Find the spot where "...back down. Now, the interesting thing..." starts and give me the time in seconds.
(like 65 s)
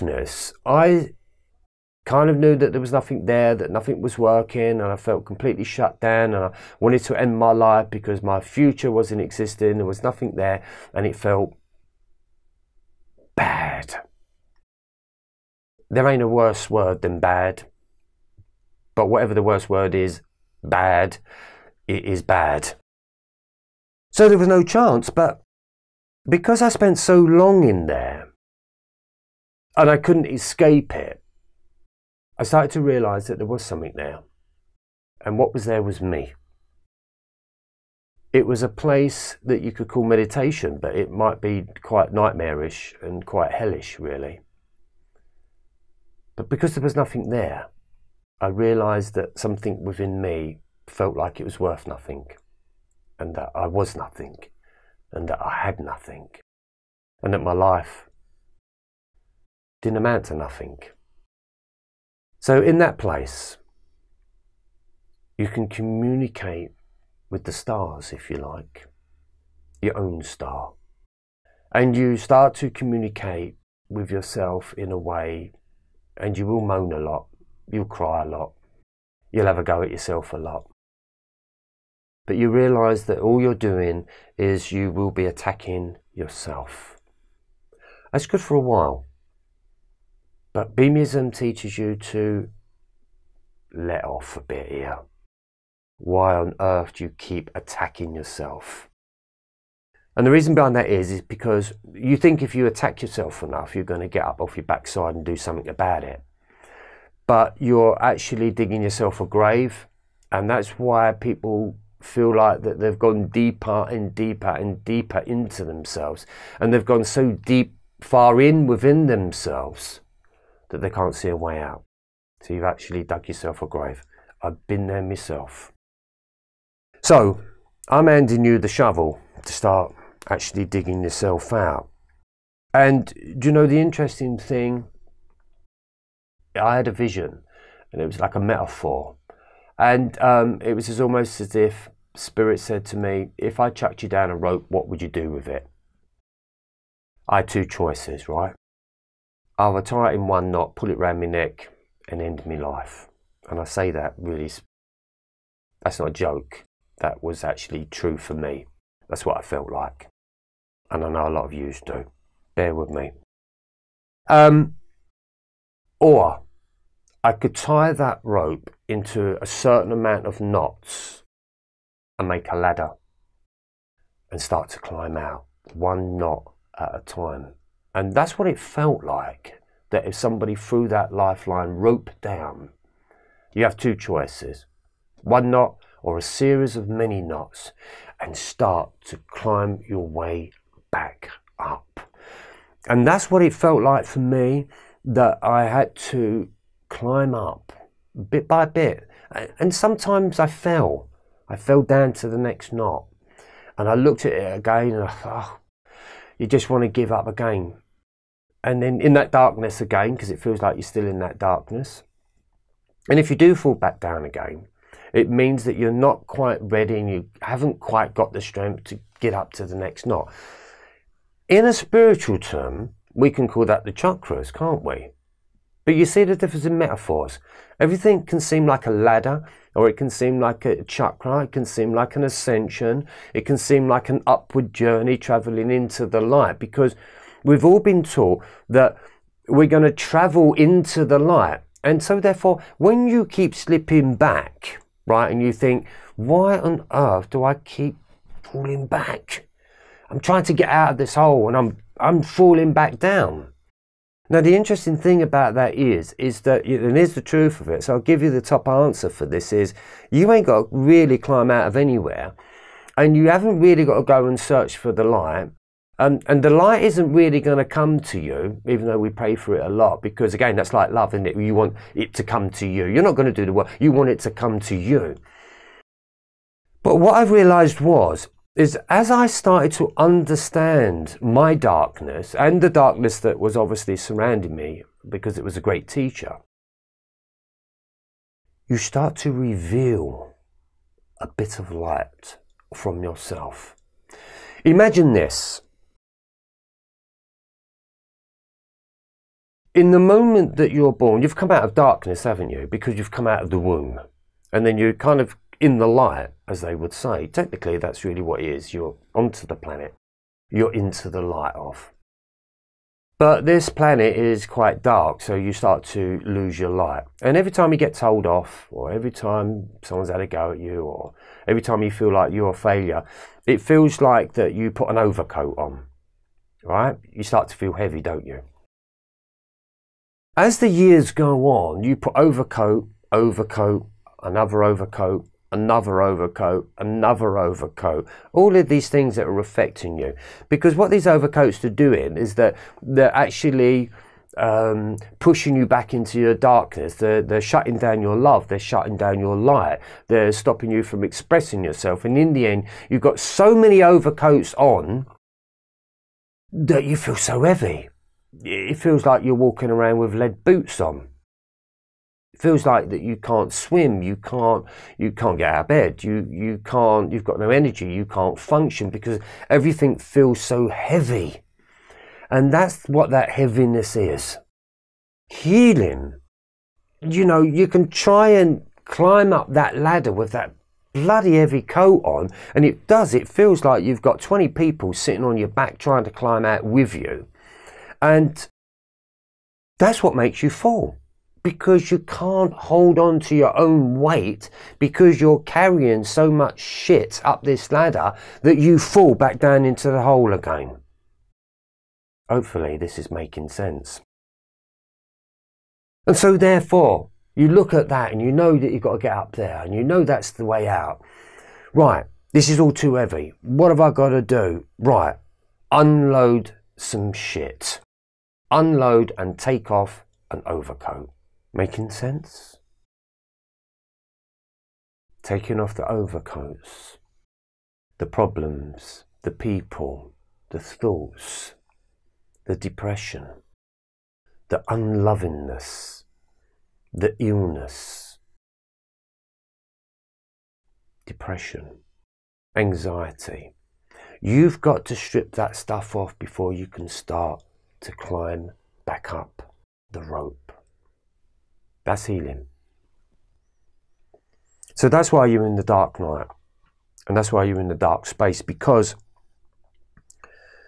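252 s.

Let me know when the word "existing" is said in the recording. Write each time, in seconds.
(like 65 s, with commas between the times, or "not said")
9 s.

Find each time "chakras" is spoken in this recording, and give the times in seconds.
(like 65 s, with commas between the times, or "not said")
223 s, 230 s.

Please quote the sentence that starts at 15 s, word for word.
There ain't a worse word than bad, but whatever the worst word is, bad, it is bad.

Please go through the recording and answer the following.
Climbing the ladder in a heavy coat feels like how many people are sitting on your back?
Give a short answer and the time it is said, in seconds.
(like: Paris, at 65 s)
20, at 384 s.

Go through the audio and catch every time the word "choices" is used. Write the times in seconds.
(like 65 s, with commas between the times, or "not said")
147 s, 183 s.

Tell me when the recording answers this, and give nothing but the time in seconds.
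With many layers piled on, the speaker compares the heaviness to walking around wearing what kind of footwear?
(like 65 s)
360 s.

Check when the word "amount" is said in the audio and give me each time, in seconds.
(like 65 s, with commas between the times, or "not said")
59 s, 169 s.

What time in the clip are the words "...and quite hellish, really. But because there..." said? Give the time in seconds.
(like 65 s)
43 s.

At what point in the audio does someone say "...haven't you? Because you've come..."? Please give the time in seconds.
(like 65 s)
302 s.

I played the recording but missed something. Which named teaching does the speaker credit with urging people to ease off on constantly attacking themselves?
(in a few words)
Beamism.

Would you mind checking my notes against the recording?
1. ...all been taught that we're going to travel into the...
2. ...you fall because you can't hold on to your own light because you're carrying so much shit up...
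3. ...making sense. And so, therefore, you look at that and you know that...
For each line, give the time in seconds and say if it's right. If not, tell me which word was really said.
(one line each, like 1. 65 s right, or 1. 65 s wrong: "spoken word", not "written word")
1. 237 s right
2. 390 s wrong: "weight", not "light"
3. 403 s right.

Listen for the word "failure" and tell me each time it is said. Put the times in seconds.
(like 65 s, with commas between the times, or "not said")
322 s.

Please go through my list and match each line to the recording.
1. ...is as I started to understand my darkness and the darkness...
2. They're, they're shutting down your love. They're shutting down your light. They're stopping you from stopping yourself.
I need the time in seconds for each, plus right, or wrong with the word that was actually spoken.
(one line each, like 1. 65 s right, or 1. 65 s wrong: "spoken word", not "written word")
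1. 278 s right
2. 346 s wrong: "expressing", not "stopping".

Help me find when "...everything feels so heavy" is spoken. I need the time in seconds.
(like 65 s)
369 s.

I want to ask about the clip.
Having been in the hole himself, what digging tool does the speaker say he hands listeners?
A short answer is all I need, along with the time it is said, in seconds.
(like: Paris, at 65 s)
the shovel, at 128 s.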